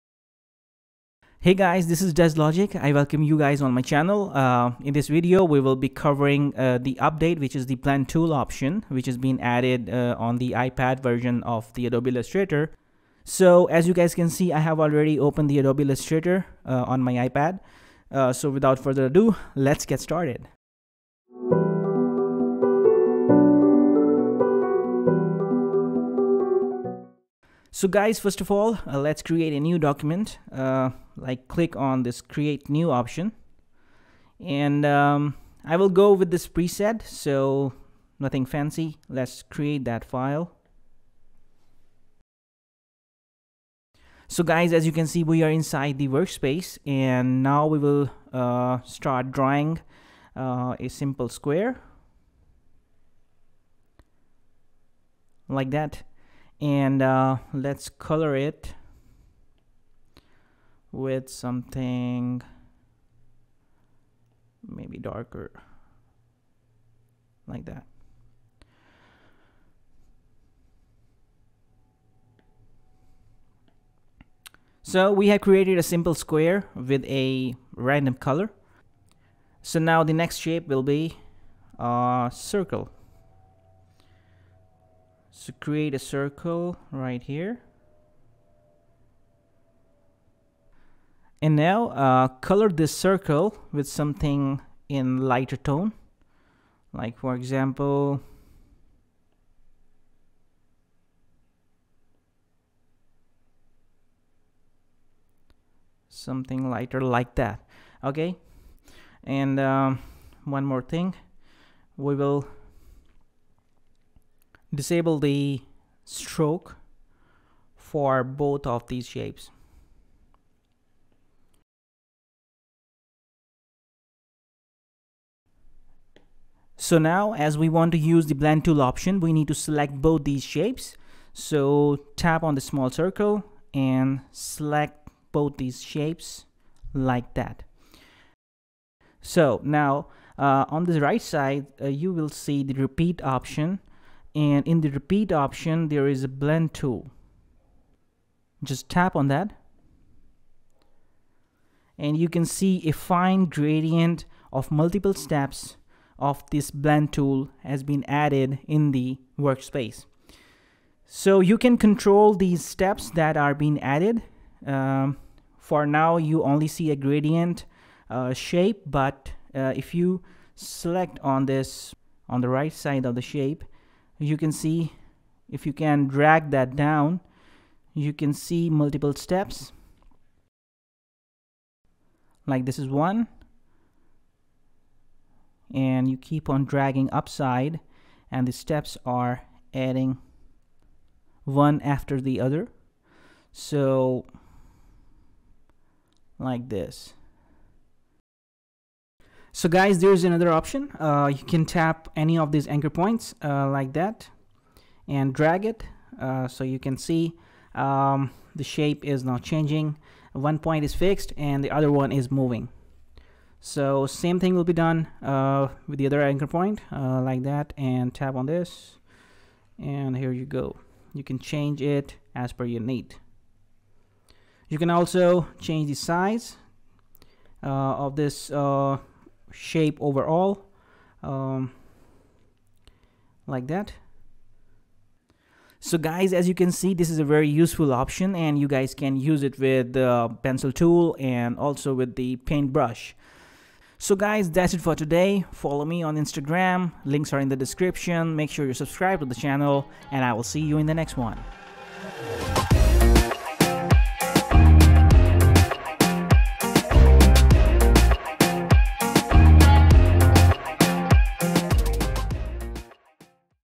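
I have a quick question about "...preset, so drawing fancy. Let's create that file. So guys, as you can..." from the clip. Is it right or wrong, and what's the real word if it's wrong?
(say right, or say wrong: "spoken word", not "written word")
wrong: "nothing", not "drawing".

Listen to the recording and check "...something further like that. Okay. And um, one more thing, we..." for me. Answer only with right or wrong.
wrong.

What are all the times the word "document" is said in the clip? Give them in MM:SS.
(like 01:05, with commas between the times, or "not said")
00:29.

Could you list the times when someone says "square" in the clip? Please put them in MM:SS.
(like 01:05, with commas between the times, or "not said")
00:51, 01:16.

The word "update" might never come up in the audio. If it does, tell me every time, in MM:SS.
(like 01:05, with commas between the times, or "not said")
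00:07.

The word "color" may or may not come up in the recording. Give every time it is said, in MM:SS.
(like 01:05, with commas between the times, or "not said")
00:57, 01:18, 01:32.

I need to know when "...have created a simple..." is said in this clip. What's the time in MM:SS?
01:15.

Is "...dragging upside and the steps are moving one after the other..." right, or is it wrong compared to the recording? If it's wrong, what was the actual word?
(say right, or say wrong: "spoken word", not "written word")
wrong: "adding", not "moving".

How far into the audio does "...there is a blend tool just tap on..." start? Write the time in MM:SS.
02:25.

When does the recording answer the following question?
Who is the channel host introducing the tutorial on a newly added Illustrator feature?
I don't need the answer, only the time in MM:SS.
00:02.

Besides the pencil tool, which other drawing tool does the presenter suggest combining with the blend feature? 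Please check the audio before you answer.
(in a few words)
paintbrush.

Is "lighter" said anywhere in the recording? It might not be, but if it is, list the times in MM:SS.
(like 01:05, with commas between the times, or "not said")
01:35, 01:46.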